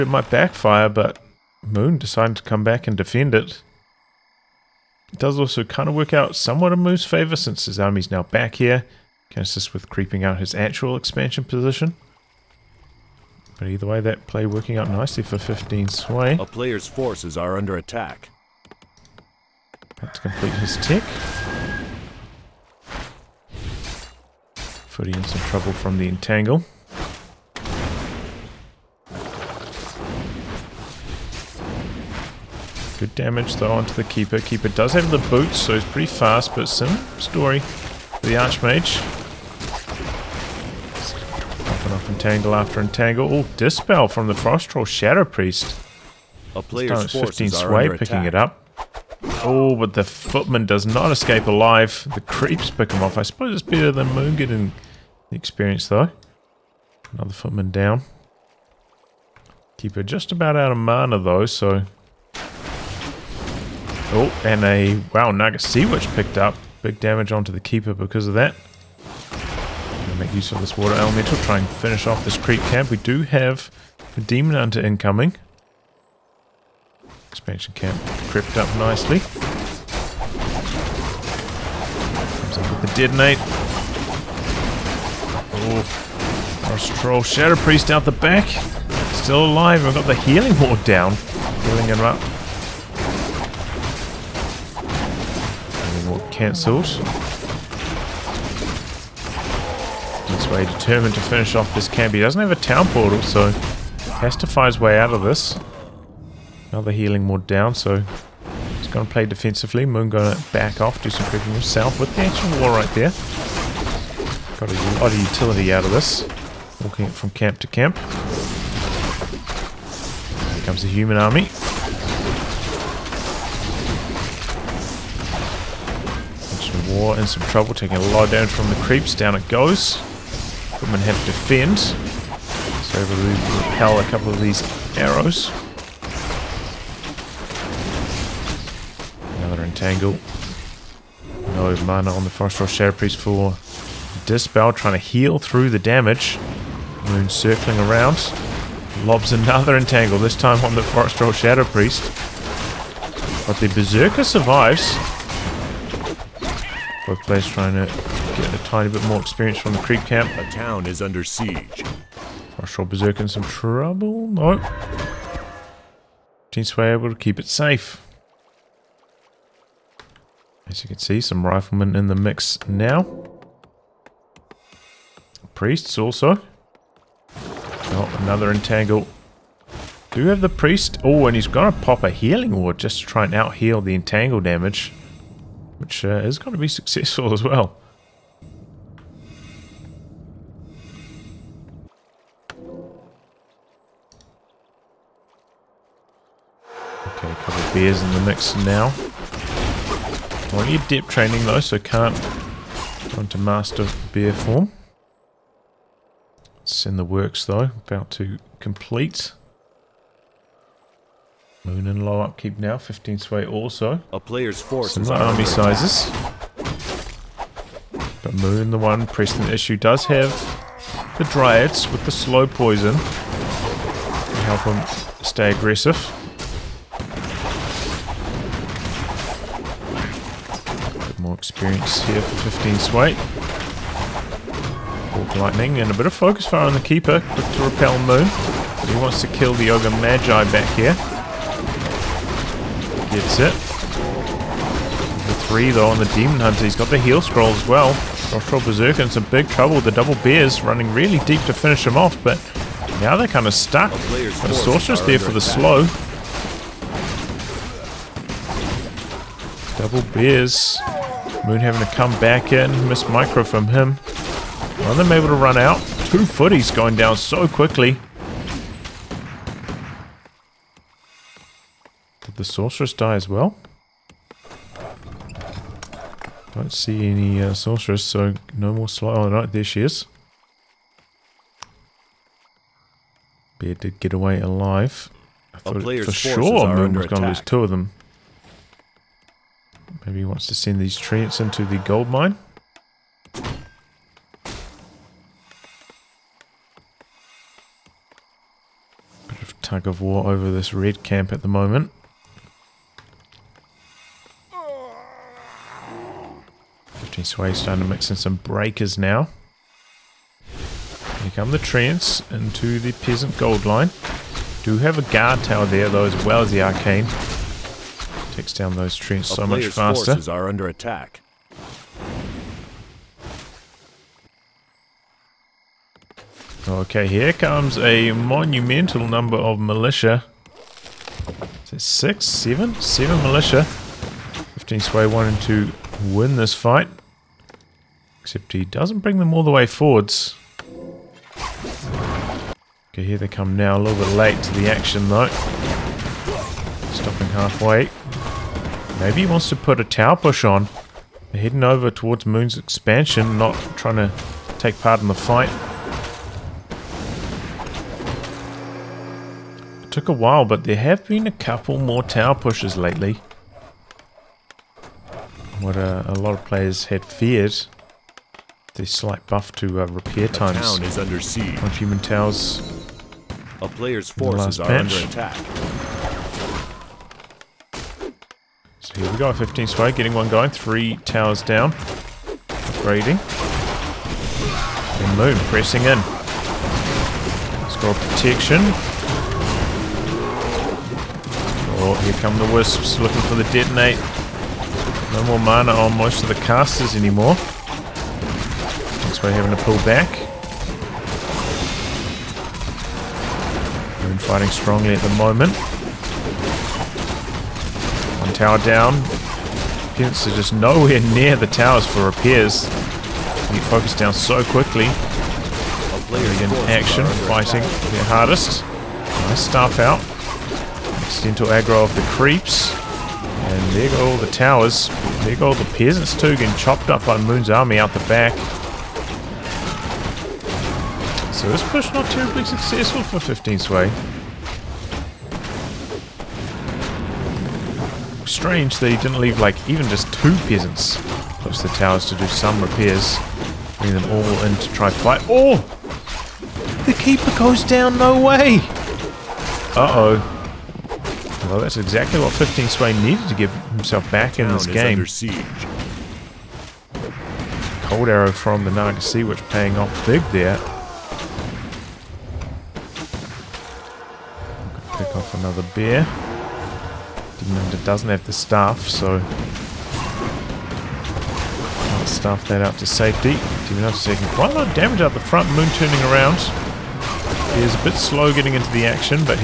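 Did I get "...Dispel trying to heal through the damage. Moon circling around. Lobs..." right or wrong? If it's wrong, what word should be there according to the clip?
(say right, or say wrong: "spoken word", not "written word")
right.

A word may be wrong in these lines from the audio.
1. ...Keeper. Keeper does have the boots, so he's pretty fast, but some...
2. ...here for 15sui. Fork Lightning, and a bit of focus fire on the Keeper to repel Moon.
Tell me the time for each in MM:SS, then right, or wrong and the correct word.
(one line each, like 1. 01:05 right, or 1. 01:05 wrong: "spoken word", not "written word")
1. 00:34 right
2. 03:52 right.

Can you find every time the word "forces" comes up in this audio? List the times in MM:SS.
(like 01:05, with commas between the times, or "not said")
00:16, 03:34, 05:20, 06:14.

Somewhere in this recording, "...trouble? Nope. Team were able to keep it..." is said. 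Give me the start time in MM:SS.
02:43.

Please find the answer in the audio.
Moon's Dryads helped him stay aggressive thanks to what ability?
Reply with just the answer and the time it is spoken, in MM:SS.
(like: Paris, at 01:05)
slow poison, at 03:42.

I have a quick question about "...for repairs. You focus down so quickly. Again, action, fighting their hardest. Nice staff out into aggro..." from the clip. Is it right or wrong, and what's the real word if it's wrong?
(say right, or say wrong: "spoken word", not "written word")
right.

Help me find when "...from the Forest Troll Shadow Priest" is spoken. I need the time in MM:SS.
00:44.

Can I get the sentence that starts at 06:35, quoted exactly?
No more mana on most of the casters anymore.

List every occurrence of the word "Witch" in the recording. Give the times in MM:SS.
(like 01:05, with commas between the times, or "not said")
01:05, 07:39.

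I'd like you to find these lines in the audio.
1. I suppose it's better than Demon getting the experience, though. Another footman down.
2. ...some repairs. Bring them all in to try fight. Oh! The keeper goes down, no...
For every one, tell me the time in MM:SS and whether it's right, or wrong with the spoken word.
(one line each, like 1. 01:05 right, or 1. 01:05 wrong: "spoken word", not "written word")
1. 00:53 wrong: "Moon", not "Demon"
2. 07:22 right.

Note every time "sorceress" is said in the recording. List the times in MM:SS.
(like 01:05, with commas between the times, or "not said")
04:14, 04:32, 04:37.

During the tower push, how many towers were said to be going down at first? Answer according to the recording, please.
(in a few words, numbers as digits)
3.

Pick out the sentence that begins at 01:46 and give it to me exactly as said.
Another healing ward down, so he's going to play defensively.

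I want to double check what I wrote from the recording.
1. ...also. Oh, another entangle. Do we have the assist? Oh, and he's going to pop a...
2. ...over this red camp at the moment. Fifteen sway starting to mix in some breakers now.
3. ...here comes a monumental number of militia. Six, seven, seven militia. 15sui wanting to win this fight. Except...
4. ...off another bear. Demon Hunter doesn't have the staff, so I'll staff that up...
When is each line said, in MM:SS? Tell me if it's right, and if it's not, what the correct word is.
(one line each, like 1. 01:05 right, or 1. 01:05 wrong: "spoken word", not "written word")
1. 02:55 wrong: "priest", not "assist"
2. 05:00 right
3. 05:27 right
4. 07:45 right.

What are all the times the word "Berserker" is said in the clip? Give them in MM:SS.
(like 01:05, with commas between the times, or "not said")
02:33, 02:42, 04:08.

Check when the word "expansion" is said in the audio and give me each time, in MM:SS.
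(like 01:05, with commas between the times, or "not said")
00:10, 01:17, 05:52.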